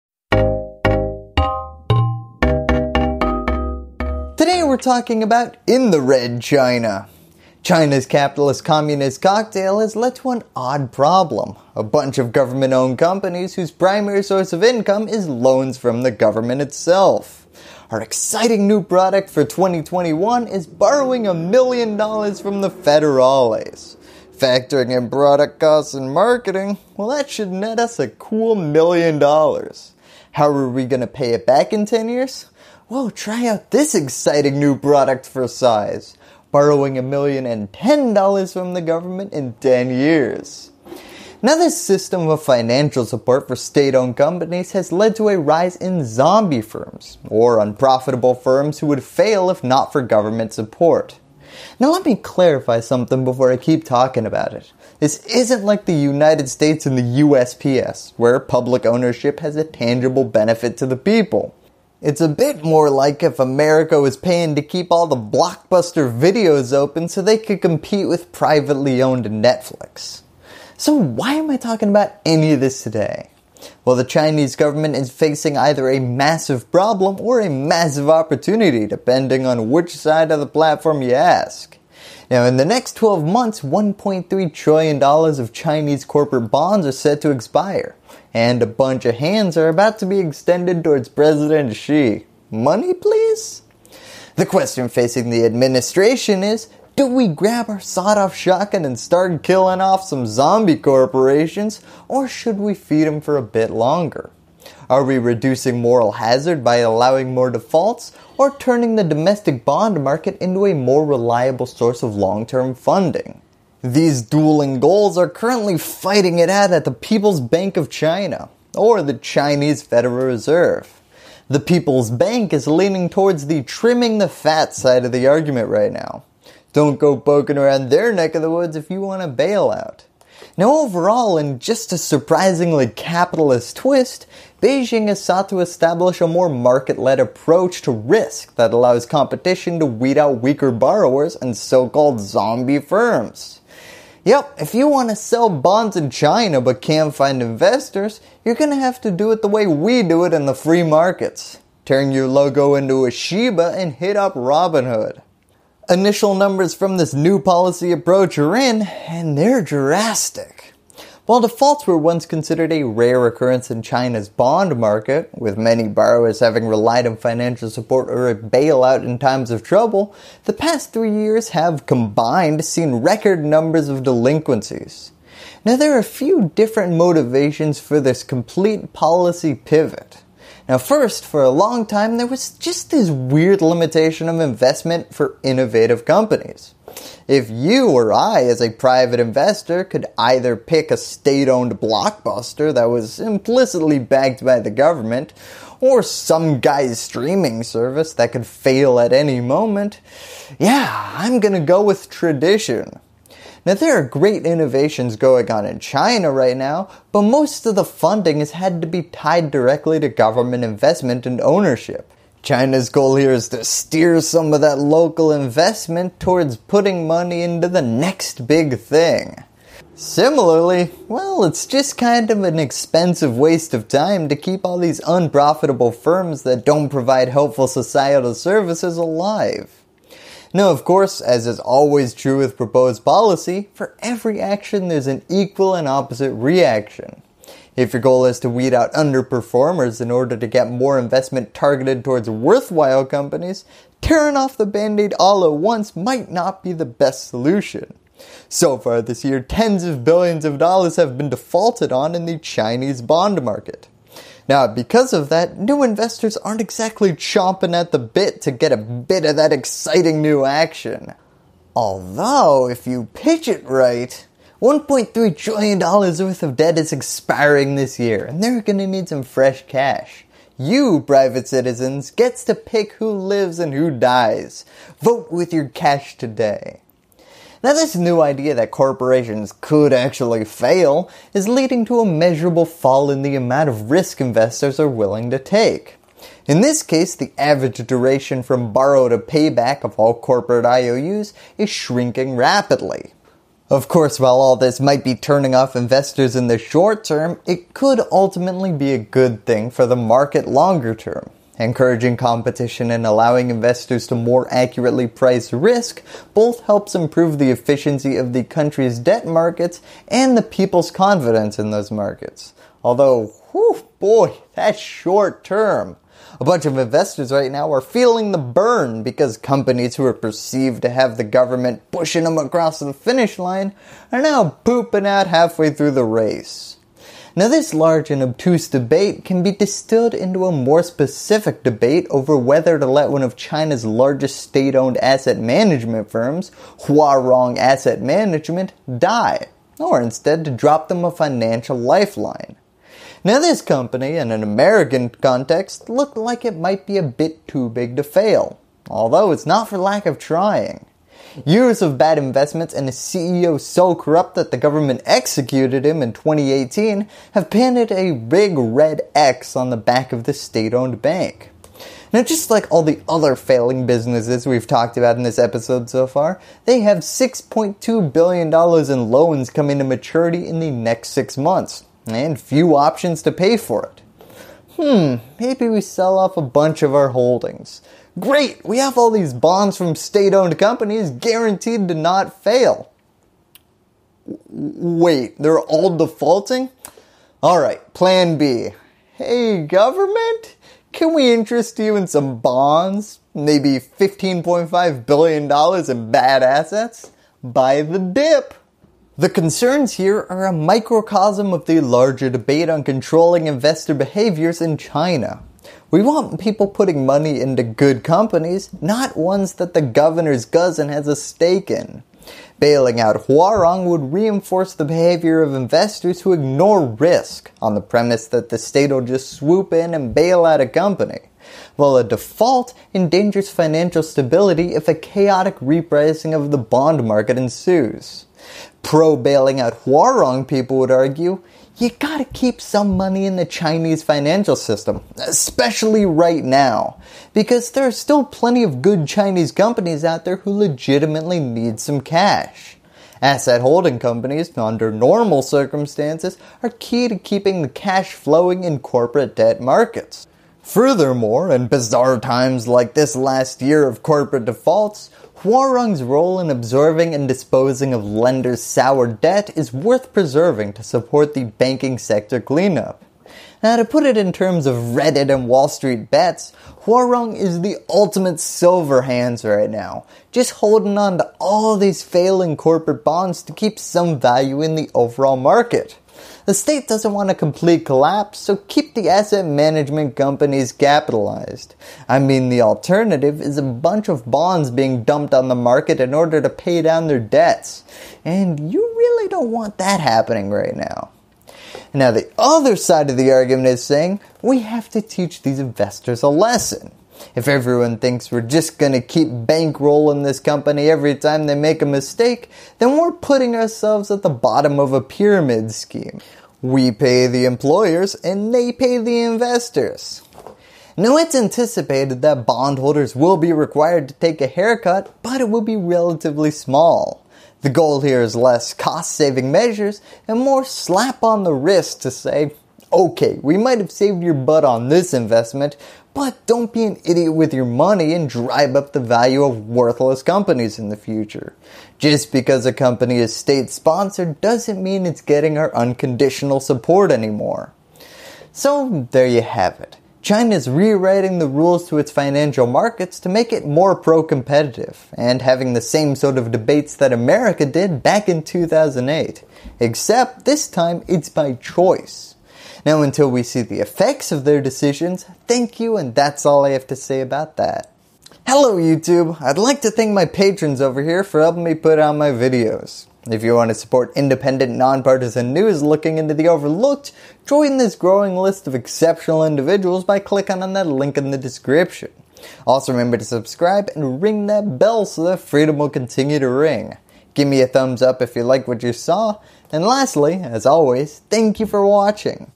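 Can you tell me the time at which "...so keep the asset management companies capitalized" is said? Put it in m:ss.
7:58.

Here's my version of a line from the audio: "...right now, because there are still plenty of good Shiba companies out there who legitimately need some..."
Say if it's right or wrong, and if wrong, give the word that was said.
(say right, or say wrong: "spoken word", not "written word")
wrong: "Chinese", not "Shiba".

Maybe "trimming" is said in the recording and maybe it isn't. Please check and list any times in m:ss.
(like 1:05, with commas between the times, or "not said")
2:03.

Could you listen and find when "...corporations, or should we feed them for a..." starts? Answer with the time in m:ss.
1:40.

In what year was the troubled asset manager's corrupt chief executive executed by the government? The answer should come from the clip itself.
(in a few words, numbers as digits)
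2018.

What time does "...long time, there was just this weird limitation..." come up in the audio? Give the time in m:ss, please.
3:01.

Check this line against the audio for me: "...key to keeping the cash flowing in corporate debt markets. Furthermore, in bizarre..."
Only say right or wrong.
right.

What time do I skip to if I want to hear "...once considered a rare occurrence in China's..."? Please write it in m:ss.
2:41.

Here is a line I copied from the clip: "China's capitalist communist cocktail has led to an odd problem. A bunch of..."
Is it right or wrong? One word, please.
right.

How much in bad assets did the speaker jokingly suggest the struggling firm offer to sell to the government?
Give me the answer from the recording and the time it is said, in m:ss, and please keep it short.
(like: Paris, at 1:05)
$15.5 billion, at 6:33.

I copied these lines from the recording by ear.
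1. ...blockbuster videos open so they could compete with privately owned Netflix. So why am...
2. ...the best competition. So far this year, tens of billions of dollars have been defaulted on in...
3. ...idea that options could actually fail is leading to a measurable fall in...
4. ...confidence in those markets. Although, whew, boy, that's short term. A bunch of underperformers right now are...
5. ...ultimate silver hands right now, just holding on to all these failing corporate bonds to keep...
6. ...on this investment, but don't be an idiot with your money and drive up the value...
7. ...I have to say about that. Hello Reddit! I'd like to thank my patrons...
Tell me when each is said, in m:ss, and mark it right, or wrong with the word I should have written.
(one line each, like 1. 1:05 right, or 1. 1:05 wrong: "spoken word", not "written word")
1. 1:05 right
2. 4:06 wrong: "solution", not "competition"
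3. 4:38 wrong: "corporations", not "options"
4. 5:10 wrong: "investors", not "underperformers"
5. 7:47 right
6. 8:44 right
7. 9:16 wrong: "YouTube", not "Reddit".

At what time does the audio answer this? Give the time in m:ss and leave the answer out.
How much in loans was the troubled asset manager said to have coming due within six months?
6:06.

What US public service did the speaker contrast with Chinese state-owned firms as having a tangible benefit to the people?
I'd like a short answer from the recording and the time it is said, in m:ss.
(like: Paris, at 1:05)
USPS, at 0:57.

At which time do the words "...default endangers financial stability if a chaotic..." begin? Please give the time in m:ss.
7:02.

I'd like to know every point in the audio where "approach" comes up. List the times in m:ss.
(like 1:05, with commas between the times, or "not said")
2:17, 2:37.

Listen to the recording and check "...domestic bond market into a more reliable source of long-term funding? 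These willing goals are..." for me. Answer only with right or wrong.
wrong.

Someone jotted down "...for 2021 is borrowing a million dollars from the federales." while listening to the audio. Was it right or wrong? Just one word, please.
right.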